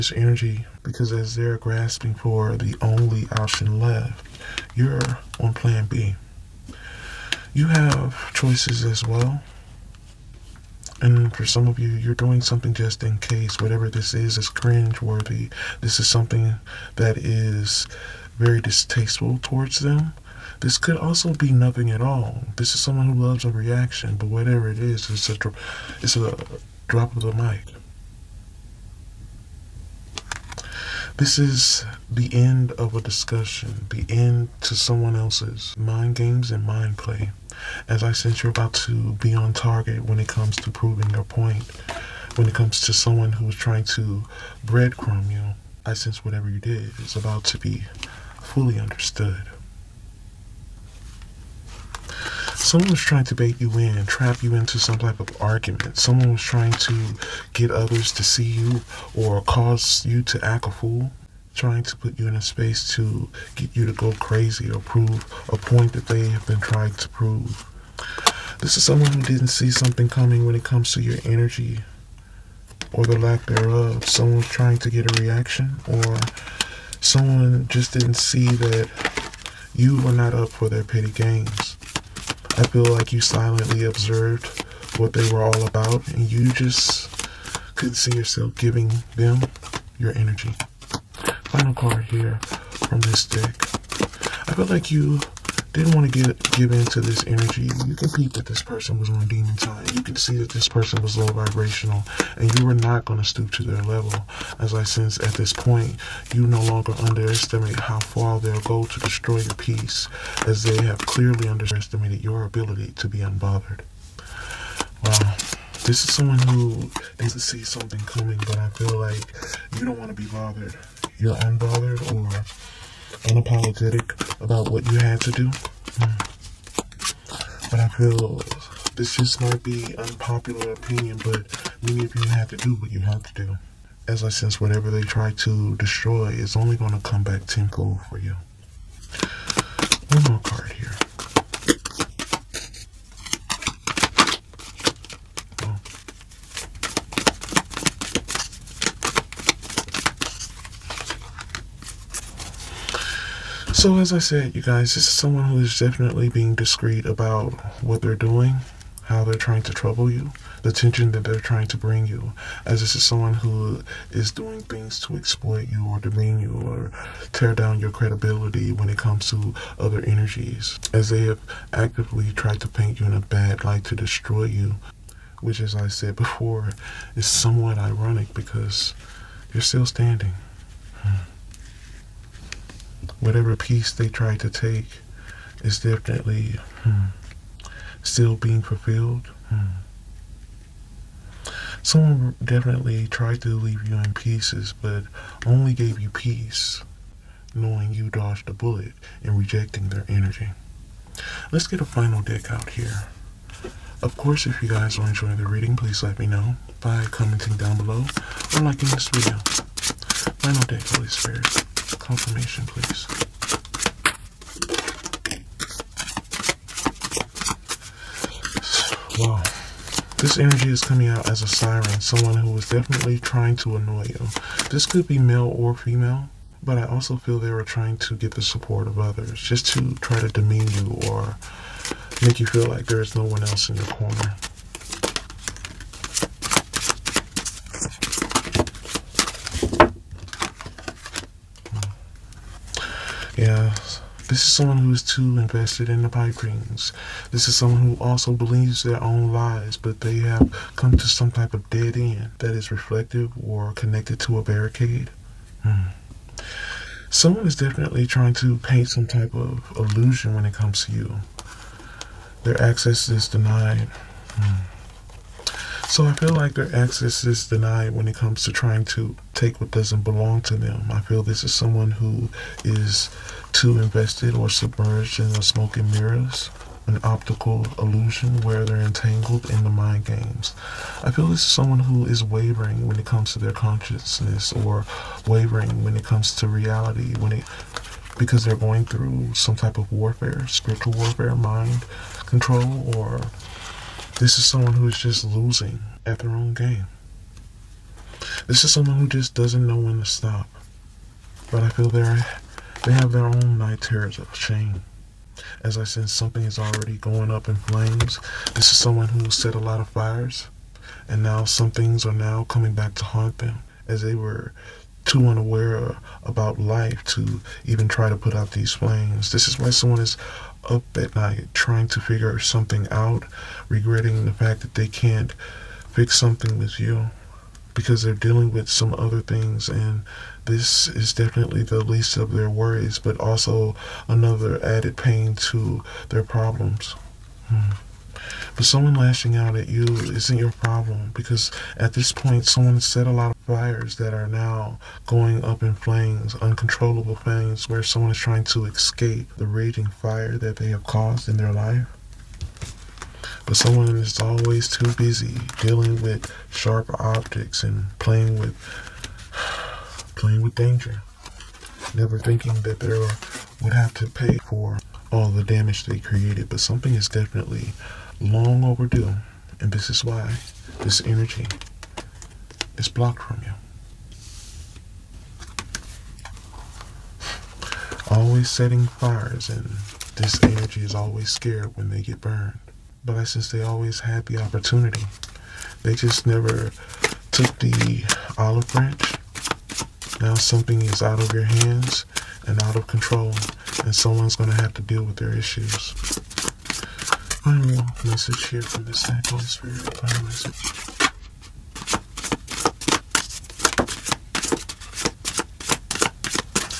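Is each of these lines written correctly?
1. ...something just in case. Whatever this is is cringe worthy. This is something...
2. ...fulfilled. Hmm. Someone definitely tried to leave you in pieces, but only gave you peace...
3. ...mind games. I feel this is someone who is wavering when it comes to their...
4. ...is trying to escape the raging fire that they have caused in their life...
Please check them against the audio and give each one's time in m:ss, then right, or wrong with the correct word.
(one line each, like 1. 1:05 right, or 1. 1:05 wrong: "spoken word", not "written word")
1. 0:12 right
2. 3:08 right
3. 4:39 right
4. 5:48 right.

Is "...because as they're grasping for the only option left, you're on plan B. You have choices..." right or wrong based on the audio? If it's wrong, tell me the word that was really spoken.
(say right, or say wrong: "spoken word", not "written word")
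right.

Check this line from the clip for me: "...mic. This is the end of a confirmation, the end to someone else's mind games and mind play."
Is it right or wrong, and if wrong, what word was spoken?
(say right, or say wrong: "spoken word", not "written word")
wrong: "discussion", not "confirmation".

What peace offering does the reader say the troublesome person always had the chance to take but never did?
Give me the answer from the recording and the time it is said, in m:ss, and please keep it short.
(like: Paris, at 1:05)
The olive branch, at 6:28.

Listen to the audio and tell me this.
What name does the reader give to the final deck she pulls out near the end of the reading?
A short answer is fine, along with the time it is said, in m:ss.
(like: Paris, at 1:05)
Holy Spirit confirmation, at 3:30.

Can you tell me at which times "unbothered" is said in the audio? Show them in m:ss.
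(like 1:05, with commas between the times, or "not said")
1:53, 2:01.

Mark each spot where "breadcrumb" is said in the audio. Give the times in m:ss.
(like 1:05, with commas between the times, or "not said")
0:44.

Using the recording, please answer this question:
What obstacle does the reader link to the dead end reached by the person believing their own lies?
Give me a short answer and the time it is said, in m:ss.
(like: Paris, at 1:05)
A barricade, at 4:14.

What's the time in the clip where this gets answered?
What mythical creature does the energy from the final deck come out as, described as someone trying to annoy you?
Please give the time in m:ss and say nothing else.
3:41.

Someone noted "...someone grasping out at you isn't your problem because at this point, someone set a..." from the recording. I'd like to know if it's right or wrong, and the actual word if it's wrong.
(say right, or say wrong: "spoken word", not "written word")
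wrong: "lashing", not "grasping".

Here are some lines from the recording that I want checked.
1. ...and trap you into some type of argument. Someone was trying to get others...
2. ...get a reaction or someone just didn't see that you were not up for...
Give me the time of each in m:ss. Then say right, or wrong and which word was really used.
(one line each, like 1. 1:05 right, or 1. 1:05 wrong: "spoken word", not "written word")
1. 0:53 right
2. 1:14 right.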